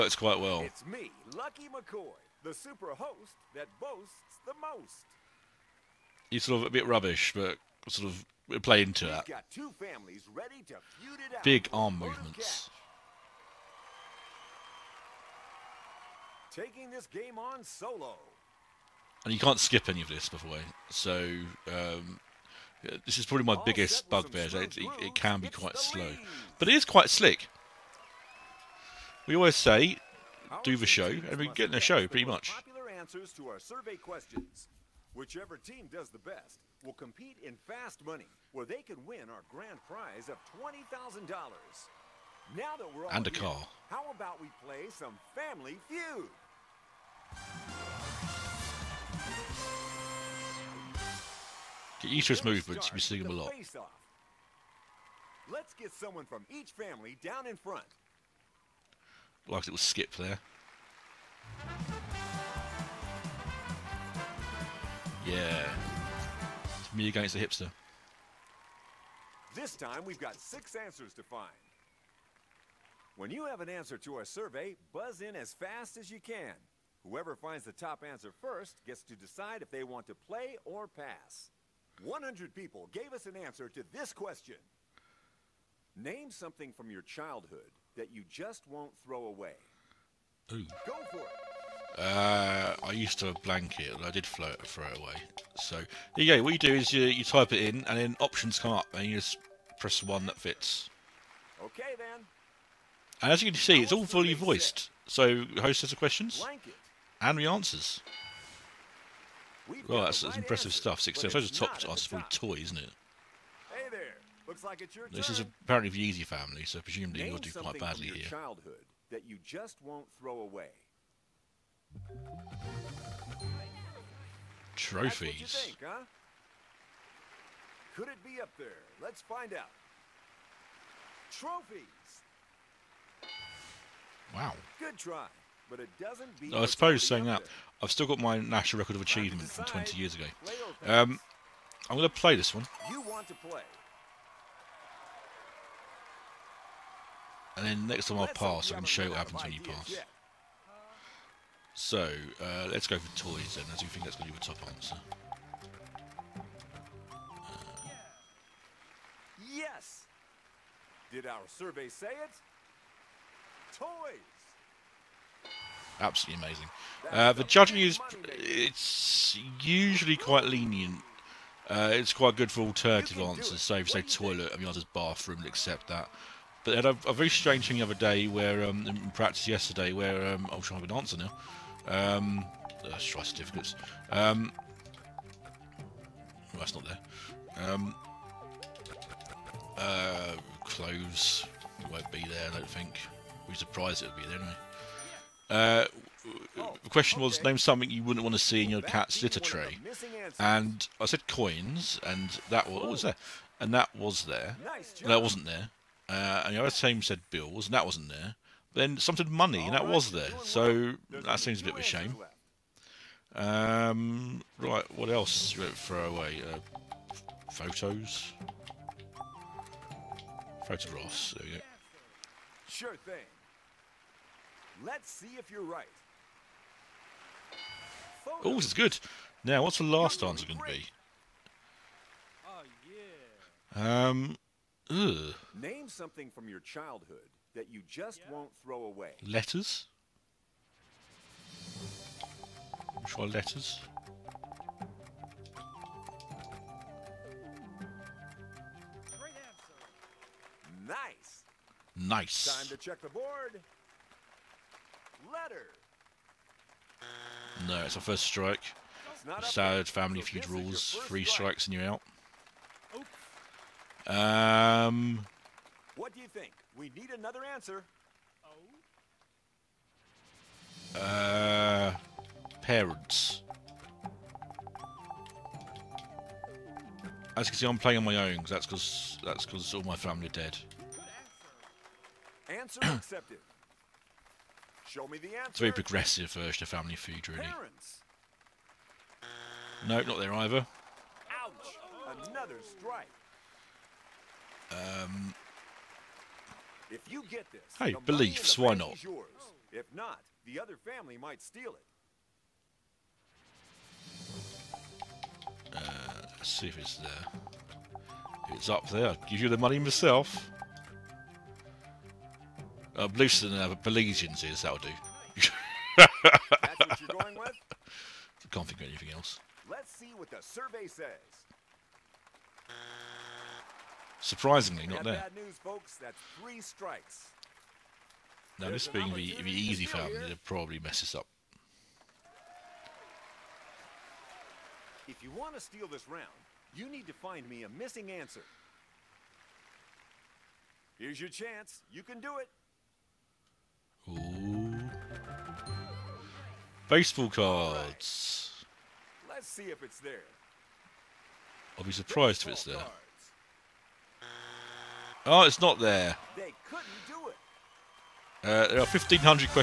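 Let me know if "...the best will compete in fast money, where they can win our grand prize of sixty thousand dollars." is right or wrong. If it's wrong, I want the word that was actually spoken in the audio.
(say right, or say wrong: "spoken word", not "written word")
wrong: "twenty", not "sixty".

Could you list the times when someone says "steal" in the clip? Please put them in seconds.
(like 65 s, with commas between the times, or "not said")
301 s, 335 s.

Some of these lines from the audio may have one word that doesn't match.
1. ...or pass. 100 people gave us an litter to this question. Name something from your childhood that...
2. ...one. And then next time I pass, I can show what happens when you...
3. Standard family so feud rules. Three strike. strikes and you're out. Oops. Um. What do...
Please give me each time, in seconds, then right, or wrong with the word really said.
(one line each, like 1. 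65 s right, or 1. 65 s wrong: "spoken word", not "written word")
1. 80 s wrong: "answer", not "litter"
2. 142 s right
3. 259 s right.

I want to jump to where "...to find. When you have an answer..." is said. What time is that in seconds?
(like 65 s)
71 s.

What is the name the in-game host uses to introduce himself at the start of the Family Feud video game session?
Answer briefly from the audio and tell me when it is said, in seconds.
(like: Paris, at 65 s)
Lucky McCoy, at 1 s.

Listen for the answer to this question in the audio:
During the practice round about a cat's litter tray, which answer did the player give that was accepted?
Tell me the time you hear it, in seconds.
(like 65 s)
201 s.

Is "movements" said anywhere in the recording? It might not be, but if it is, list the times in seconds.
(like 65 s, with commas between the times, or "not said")
11 s, 52 s.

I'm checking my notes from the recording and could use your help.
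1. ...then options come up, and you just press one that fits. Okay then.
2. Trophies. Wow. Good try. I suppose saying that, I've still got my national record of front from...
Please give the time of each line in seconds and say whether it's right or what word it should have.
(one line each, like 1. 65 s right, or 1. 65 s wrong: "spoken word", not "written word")
1. 97 s right
2. 131 s wrong: "achievement", not "front".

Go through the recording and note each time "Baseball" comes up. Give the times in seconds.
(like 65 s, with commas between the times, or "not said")
346 s, 352 s.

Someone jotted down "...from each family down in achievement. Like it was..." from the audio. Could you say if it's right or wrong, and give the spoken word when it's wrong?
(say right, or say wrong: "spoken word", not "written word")
wrong: "front", not "achievement".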